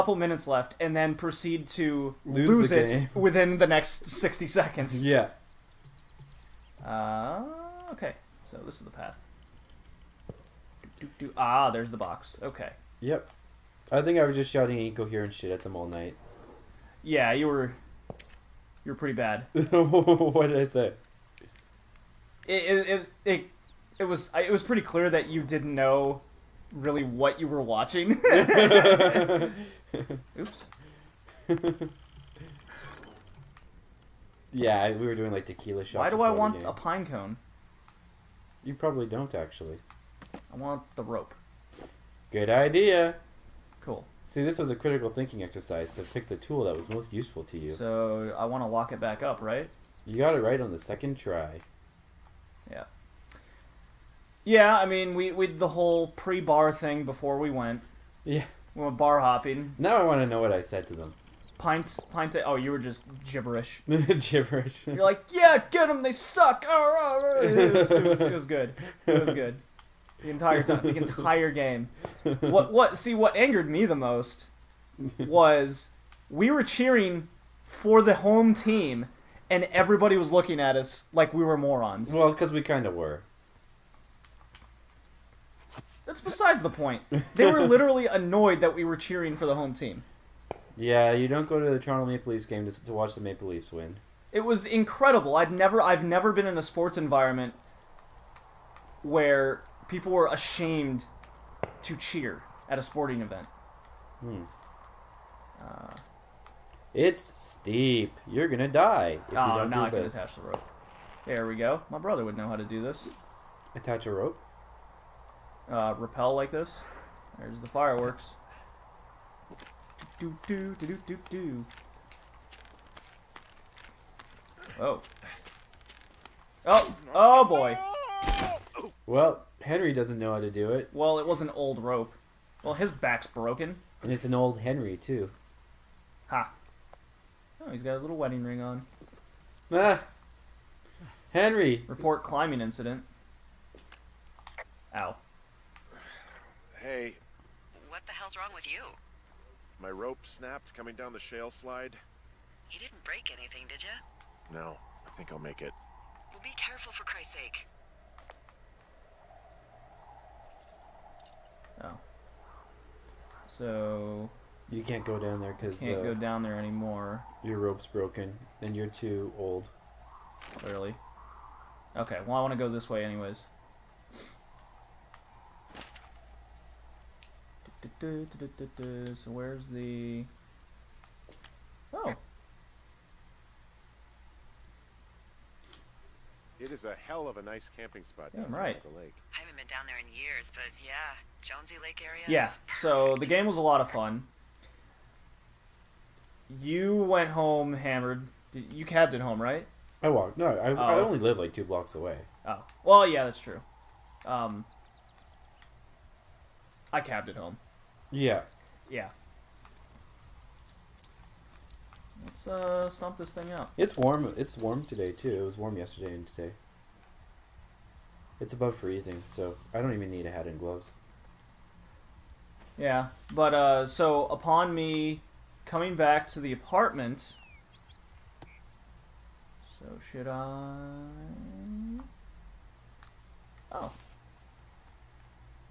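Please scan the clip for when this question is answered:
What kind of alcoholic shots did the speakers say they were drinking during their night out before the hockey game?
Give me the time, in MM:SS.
00:35.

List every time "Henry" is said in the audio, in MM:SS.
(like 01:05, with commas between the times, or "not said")
02:09, 02:14, 02:21.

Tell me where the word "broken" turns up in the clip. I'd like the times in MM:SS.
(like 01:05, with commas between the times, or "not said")
02:13, 02:47.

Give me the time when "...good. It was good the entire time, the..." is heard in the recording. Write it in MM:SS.
01:08.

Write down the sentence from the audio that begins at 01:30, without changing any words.
Yeah, you don't go to the Toronto Maple Leafs game to, to watch the Maple Leafs win.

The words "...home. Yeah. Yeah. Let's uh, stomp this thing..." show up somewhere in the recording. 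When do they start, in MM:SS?
03:27.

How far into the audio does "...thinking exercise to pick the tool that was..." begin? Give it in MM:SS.
00:45.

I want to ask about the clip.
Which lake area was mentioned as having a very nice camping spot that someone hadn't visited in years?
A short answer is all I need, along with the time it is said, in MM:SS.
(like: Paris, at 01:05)
Jonesy Lake, at 03:11.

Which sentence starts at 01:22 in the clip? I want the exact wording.
Well, because we kind of were.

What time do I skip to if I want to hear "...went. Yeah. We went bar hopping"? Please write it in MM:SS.
00:57.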